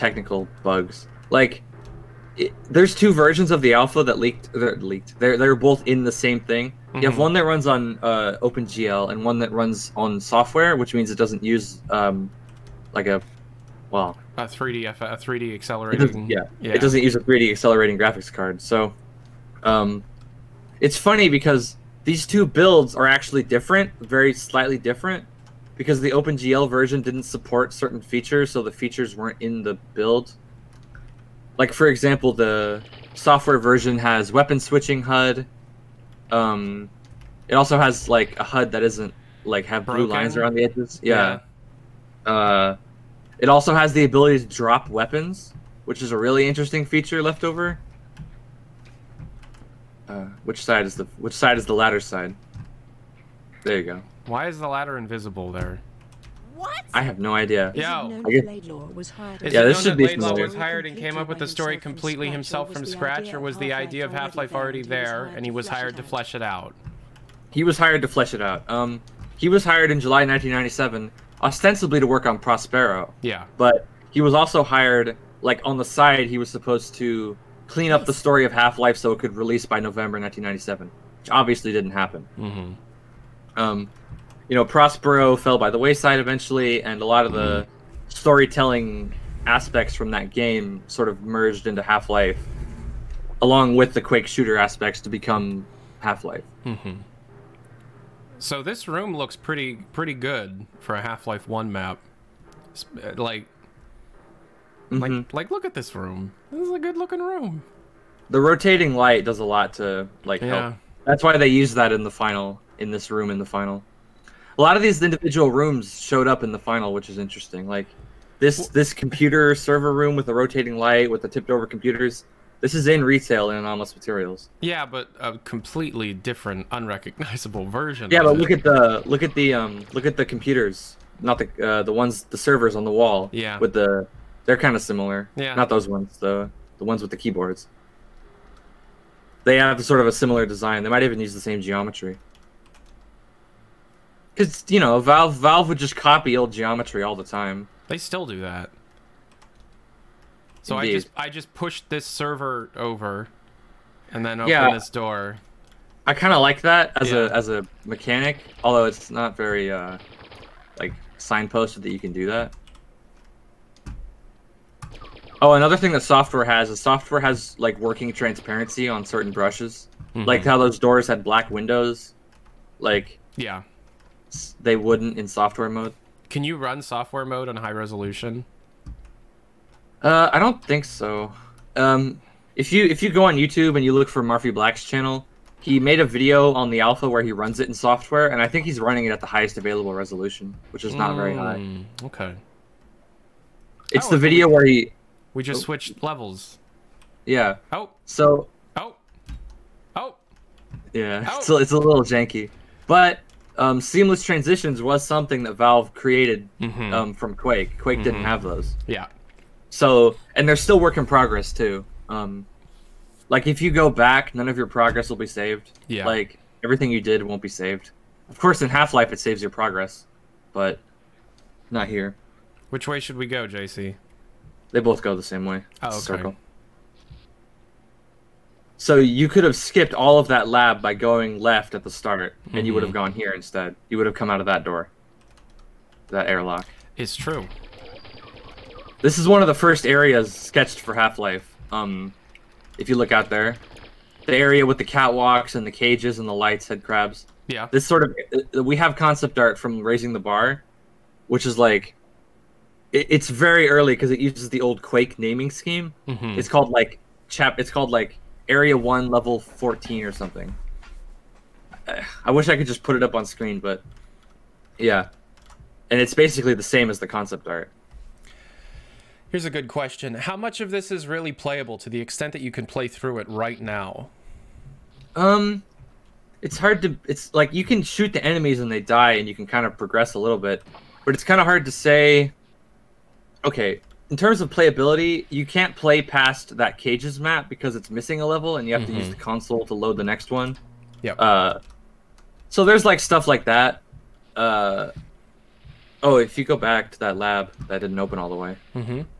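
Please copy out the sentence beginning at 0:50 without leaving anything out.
Uh, which side is the which side is the ladder side?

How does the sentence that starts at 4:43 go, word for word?
Okay, in terms of playability, you can't play past that cages map because it's missing a level, and you have mm -hmm.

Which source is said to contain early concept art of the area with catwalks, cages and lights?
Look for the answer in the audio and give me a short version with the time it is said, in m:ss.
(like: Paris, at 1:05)
Raising the Bar, at 4:09.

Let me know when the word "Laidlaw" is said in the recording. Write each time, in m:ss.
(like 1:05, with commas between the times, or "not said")
1:00.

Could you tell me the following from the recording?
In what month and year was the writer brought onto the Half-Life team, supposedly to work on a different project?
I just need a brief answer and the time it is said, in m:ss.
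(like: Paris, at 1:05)
July 1997, at 1:09.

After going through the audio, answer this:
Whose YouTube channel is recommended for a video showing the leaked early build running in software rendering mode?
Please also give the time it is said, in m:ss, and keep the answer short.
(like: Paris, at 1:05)
Murphy Black, at 3:04.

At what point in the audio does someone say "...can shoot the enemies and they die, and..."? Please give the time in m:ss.
4:37.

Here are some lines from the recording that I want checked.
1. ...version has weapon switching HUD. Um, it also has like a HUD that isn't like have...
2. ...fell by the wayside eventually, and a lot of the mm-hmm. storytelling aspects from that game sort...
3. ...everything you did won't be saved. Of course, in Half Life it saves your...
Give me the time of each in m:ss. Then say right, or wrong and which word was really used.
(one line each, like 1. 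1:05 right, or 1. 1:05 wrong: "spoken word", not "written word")
1. 0:33 right
2. 1:25 right
3. 3:36 right.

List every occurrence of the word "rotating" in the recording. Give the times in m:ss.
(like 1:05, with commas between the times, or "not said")
1:48, 2:00.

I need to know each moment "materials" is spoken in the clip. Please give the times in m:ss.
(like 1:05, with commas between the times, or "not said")
2:03.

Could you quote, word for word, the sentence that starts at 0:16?
yeah, yeah, it doesn't use a 3D accelerating graphics card.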